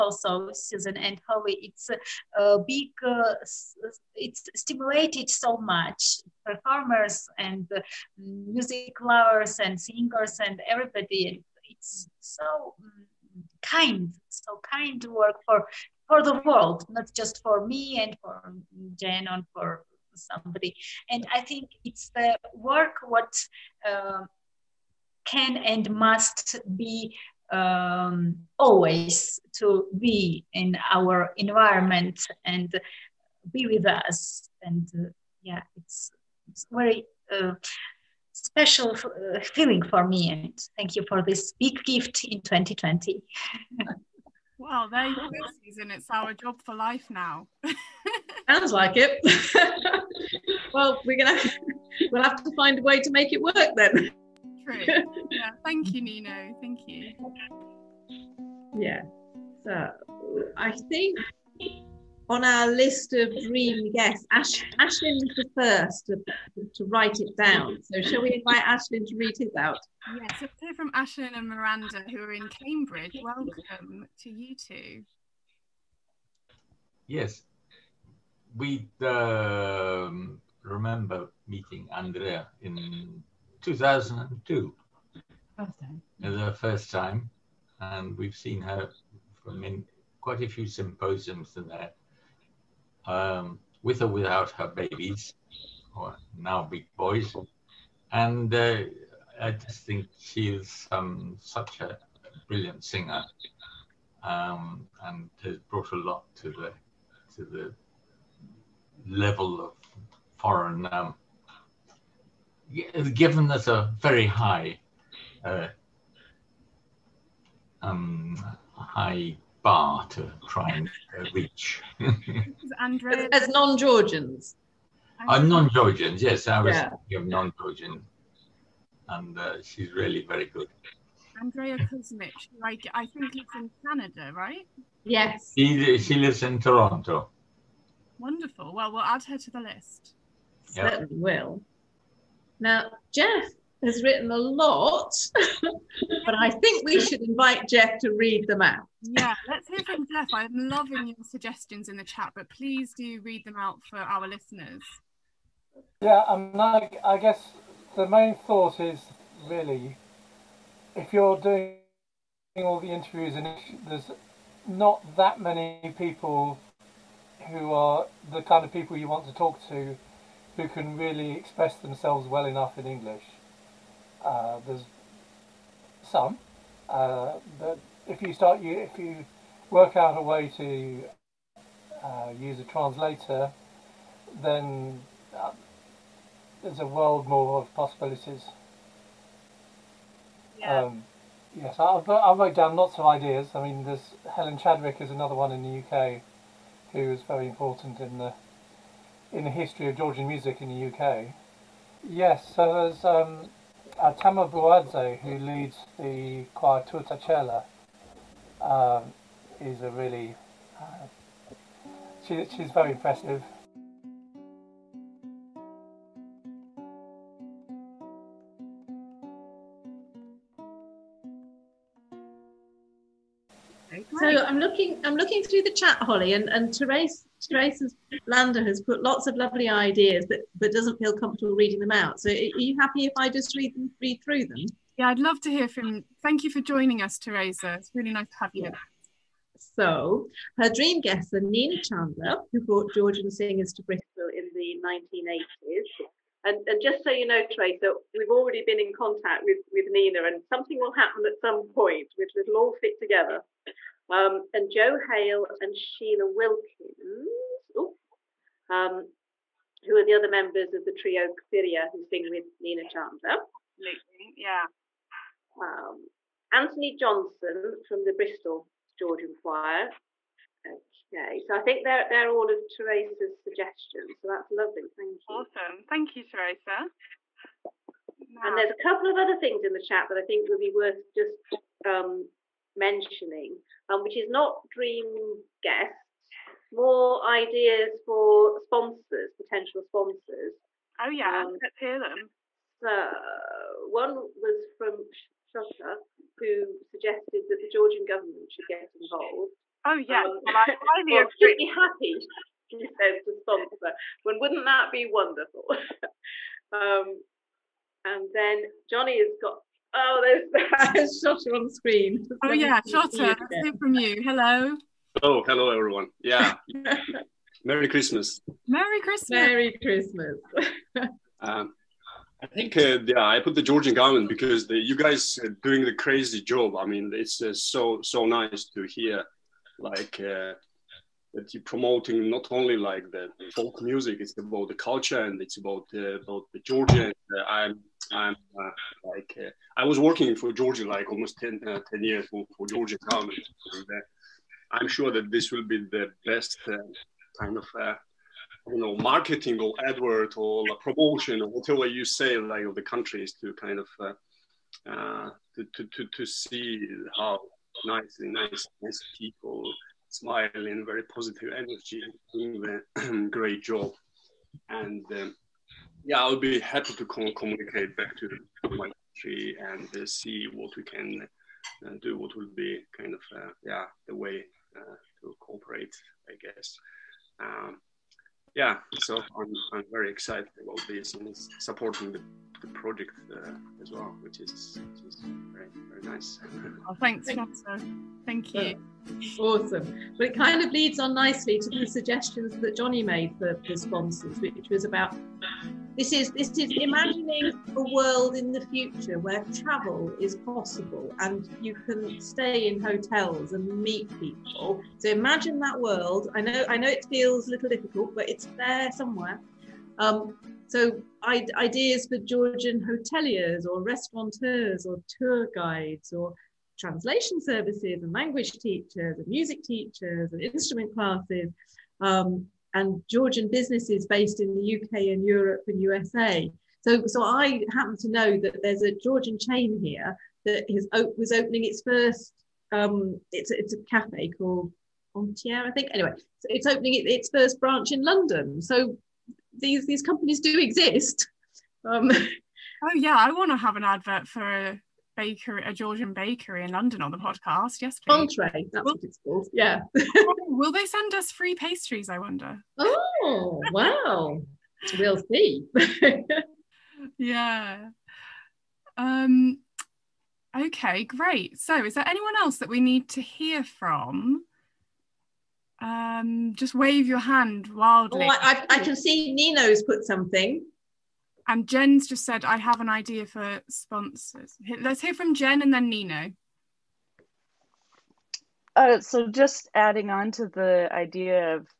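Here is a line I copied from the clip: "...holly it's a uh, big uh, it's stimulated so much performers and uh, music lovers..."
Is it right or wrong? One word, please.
right.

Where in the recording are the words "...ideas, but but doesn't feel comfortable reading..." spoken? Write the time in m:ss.
3:49.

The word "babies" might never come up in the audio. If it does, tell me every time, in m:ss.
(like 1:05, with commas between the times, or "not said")
1:34.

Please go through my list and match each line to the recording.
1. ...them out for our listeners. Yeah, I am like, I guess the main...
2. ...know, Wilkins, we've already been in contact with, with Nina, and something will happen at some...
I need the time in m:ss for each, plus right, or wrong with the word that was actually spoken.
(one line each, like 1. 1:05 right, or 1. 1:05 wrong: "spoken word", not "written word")
1. 2:33 right
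2. 4:07 wrong: "Teresa", not "Wilkins".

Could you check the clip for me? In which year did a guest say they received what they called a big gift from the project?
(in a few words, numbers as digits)
2020.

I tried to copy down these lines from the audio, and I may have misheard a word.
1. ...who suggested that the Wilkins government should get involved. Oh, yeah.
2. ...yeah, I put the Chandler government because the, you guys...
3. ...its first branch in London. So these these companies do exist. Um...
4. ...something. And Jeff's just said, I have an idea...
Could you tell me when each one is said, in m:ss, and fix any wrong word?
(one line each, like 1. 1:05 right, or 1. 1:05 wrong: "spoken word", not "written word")
1. 4:56 wrong: "Georgian", not "Wilkins"
2. 5:23 wrong: "Georgian", not "Chandler"
3. 7:17 right
4. 7:50 wrong: "Jen", not "Jeff".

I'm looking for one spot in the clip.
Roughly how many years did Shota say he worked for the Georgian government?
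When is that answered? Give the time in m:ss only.
5:41.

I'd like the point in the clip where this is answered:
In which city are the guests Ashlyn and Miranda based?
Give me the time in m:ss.
1:12.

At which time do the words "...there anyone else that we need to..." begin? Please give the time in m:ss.
7:41.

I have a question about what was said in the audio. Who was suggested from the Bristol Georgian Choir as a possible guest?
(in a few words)
Anthony Johnson.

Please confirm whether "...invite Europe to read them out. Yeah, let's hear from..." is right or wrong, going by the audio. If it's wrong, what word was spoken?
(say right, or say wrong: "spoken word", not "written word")
wrong: "Jeff", not "Europe".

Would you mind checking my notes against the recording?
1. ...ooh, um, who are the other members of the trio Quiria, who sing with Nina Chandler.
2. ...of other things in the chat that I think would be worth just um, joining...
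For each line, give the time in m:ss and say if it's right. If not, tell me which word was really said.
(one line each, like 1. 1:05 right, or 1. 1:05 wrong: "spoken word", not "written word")
1. 4:17 right
2. 4:39 wrong: "mentioning", not "joining".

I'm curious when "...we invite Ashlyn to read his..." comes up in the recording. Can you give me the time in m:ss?
1:08.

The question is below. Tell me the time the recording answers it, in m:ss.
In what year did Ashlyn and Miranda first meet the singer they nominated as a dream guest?
1:23.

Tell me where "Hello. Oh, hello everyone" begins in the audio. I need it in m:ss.
5:14.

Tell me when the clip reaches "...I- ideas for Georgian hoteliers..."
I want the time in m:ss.
6:51.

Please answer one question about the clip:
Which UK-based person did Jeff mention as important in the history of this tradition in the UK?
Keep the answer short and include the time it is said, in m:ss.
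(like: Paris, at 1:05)
Helen Chadwick, at 3:14.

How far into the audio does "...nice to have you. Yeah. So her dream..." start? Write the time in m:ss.
3:58.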